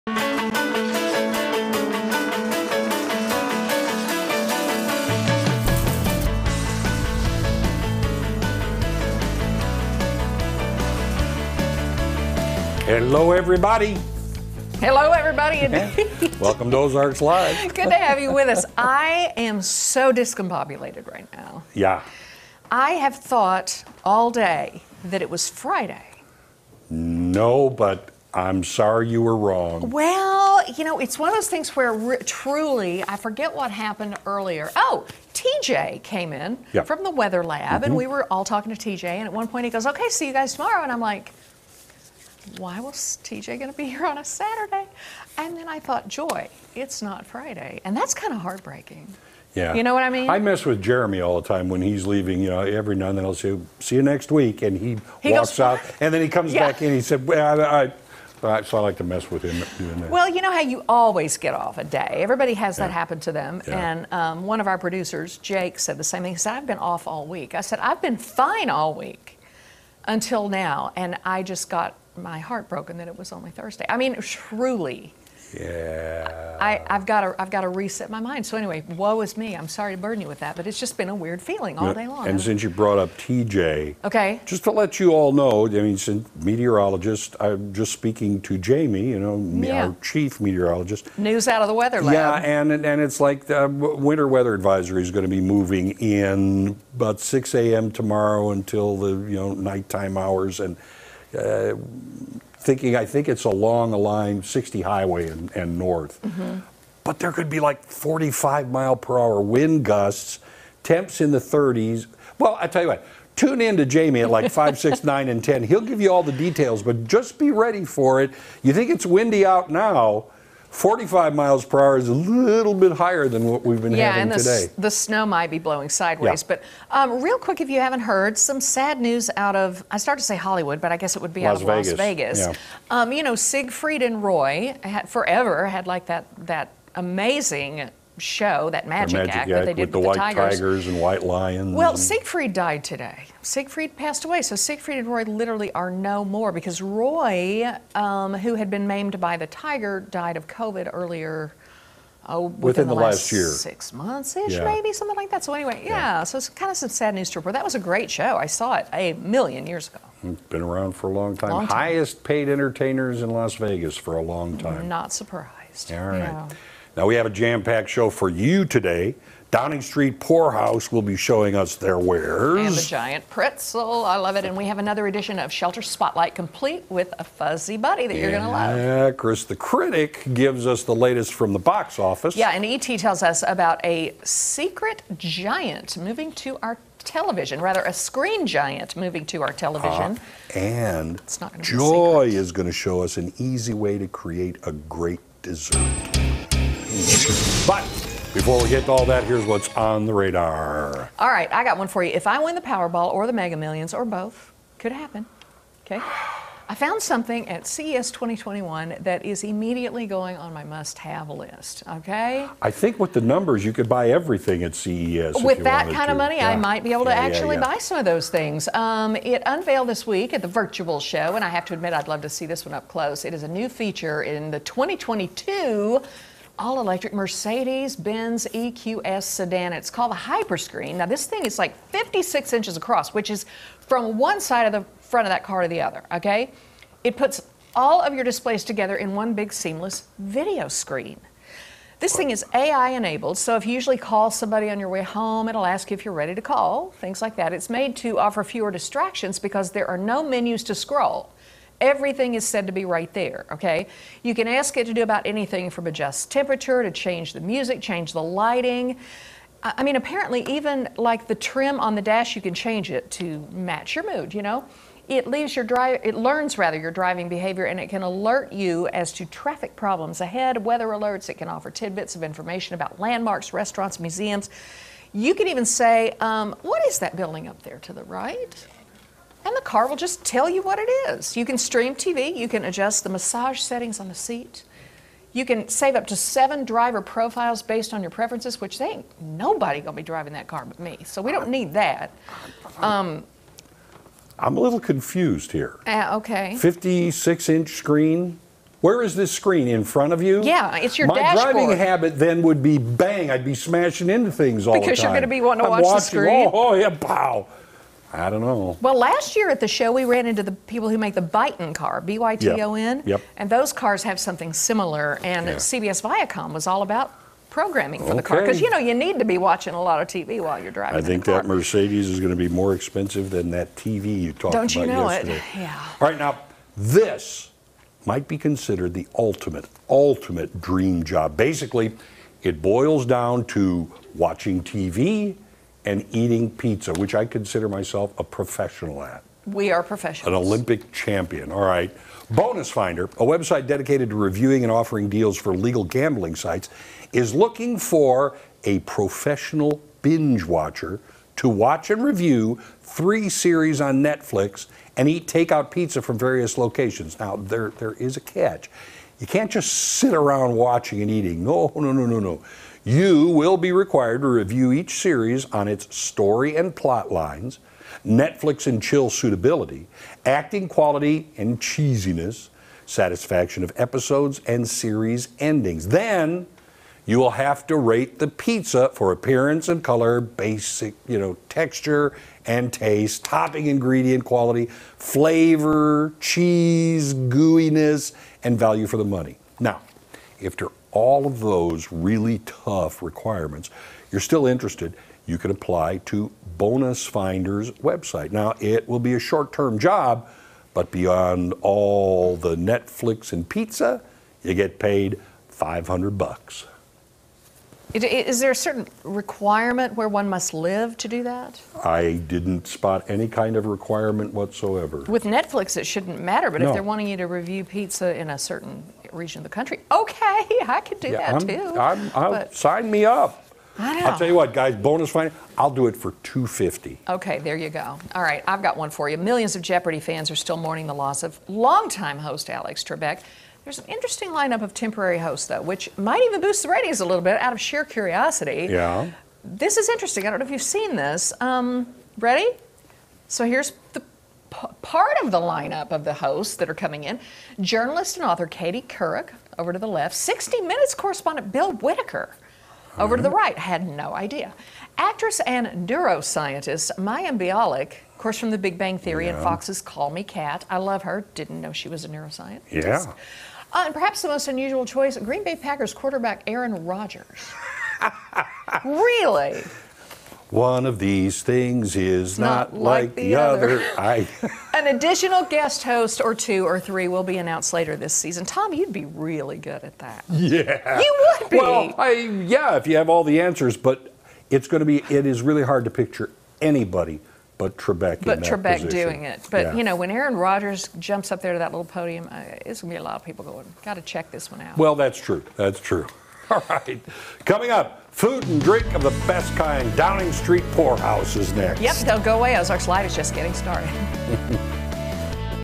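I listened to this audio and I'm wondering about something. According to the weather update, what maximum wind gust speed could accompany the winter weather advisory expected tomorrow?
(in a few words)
45 mph.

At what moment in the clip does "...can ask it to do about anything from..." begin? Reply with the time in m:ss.
4:14.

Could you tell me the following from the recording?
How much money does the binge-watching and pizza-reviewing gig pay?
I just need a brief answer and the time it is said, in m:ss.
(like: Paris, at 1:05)
$500, at 6:45.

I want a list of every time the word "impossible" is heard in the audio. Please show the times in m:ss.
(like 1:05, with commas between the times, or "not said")
not said.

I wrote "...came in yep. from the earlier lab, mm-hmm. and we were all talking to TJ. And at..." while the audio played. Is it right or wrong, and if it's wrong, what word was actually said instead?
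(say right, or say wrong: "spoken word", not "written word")
wrong: "weather", not "earlier".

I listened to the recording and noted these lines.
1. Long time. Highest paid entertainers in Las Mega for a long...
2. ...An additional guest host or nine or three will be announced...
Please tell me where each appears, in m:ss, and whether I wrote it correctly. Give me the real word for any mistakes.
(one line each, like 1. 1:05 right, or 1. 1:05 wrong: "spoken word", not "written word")
1. 2:41 wrong: "Vegas", not "Mega"
2. 7:54 wrong: "two", not "nine".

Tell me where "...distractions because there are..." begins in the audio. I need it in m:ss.
4:08.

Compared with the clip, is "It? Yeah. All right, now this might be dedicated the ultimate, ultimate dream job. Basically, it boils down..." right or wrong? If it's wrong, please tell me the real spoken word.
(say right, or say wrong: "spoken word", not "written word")
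wrong: "considered", not "dedicated".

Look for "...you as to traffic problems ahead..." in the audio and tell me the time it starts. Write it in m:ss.
4:28.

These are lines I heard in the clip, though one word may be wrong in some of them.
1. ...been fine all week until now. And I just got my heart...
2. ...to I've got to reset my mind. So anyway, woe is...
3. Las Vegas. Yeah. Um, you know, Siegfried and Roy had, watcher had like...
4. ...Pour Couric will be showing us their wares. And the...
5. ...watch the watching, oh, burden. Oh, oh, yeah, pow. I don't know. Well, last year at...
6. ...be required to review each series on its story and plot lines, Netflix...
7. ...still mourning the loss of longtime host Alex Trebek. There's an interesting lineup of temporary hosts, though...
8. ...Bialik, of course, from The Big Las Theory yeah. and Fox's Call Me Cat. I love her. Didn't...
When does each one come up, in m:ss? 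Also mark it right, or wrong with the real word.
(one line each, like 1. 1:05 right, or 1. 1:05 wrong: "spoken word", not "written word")
1. 1:08 right
2. 1:17 right
3. 2:11 wrong: "forever", not "watcher"
4. 2:50 wrong: "House", not "Couric"
5. 5:05 wrong: "screen", not "burden"
6. 6:03 right
7. 7:10 right
8. 7:37 wrong: "Bang", not "Las".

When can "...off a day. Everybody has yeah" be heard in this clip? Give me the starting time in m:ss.
1:01.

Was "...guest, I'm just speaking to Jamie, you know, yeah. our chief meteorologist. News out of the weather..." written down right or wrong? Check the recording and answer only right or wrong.
wrong.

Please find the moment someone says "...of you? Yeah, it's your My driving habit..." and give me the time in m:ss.
5:00.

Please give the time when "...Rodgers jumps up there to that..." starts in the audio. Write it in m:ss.
8:10.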